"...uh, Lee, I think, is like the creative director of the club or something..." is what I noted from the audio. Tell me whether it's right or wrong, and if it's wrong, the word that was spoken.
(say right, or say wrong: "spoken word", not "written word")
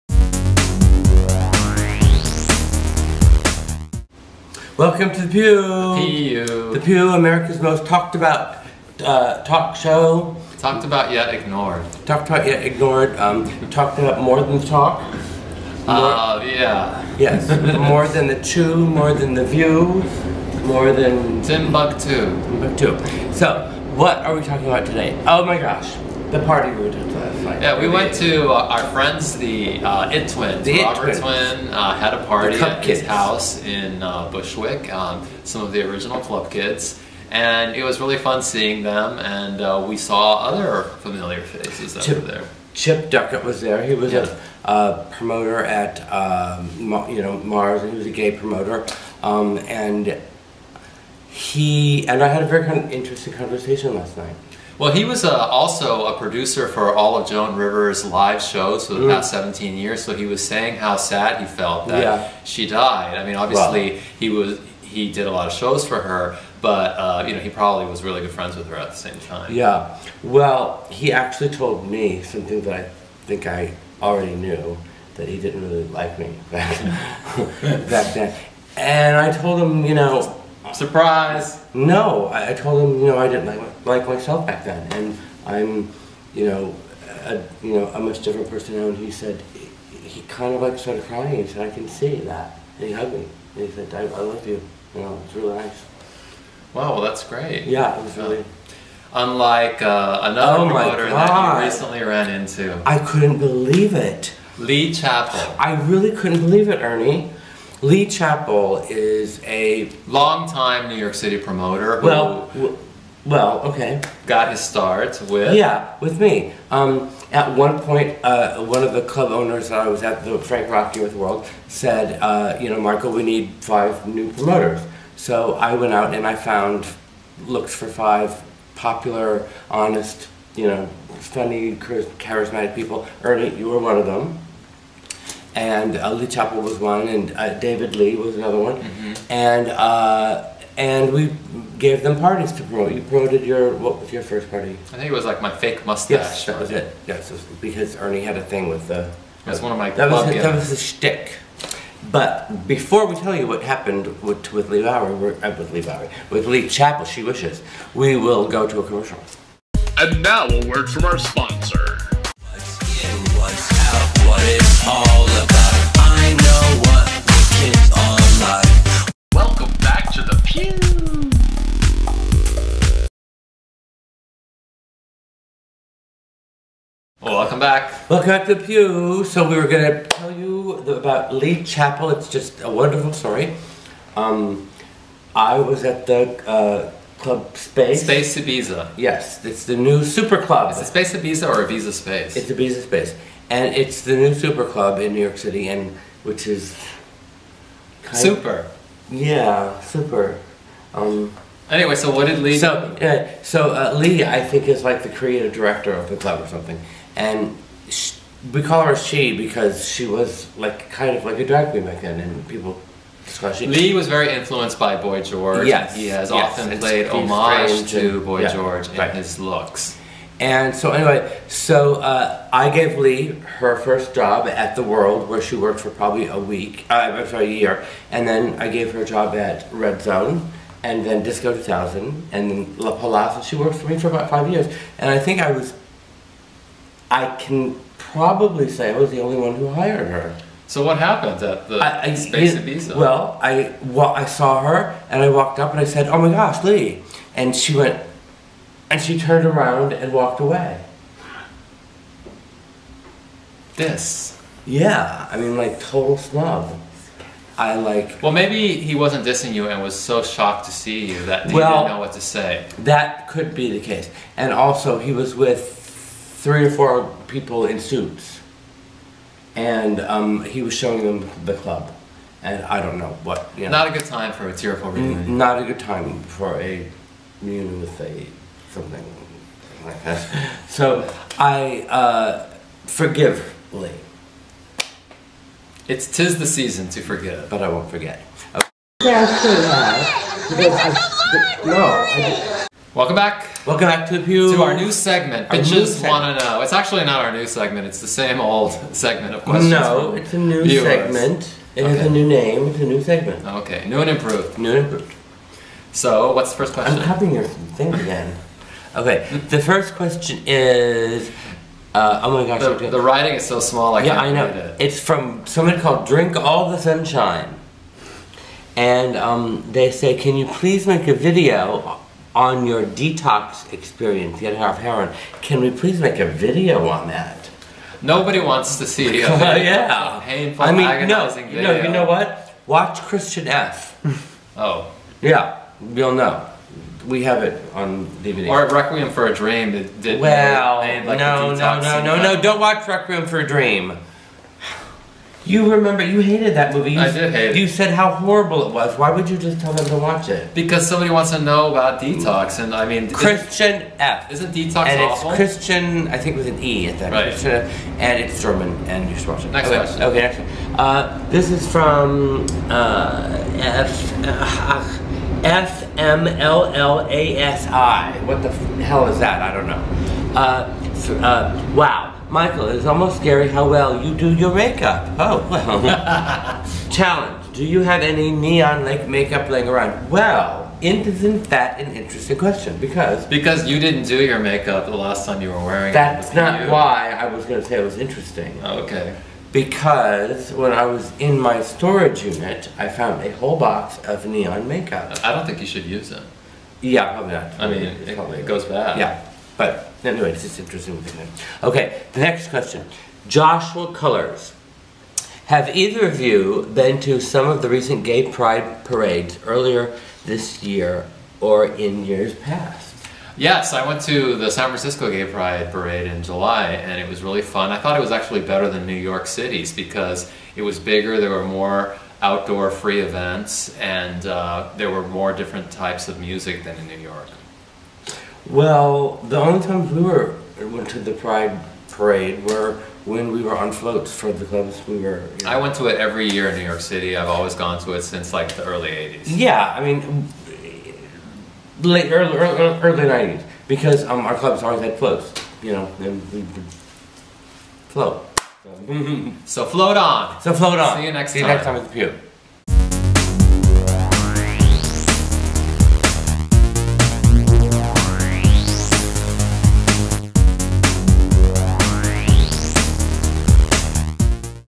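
right.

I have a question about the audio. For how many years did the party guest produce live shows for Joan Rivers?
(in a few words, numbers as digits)
17.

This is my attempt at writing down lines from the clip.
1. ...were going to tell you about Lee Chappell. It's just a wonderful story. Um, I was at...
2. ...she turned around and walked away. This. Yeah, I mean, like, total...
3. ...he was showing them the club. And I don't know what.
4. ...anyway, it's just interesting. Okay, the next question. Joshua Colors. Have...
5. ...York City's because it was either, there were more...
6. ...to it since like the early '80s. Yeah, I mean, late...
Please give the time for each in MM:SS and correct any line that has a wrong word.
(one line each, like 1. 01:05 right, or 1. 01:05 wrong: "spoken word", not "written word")
1. 02:59 right
2. 04:09 right
3. 04:30 right
4. 06:40 right
5. 06:58 wrong: "bigger", not "either"
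6. 07:17 right.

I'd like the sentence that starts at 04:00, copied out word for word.
So what happened at the I, I, Space it, Ibiza?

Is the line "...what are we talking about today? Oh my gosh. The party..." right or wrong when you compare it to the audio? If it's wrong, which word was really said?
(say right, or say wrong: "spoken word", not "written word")
right.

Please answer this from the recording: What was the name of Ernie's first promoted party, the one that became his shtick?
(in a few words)
My Fake Mustache.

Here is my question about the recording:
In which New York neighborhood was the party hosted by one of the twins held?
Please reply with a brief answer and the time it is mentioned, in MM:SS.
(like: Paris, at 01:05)
Bushwick, at 00:34.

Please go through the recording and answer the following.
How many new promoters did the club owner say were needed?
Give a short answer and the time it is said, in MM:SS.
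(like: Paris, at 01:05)
5, at 02:03.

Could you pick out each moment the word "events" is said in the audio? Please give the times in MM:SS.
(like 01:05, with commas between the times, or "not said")
07:02.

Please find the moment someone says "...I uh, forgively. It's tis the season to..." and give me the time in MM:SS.
04:41.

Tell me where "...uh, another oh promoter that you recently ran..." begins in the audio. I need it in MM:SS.
01:39.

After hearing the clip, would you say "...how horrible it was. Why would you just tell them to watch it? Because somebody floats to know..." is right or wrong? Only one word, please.
wrong.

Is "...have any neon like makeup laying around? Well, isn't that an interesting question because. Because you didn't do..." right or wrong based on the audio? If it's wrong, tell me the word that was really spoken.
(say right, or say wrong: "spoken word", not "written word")
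right.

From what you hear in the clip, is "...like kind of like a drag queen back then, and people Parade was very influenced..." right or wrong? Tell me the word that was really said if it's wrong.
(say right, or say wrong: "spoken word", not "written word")
wrong: "Lee", not "Parade".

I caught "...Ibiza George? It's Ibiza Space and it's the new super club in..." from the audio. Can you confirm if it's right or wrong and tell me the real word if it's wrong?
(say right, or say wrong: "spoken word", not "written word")
wrong: "Space", not "George".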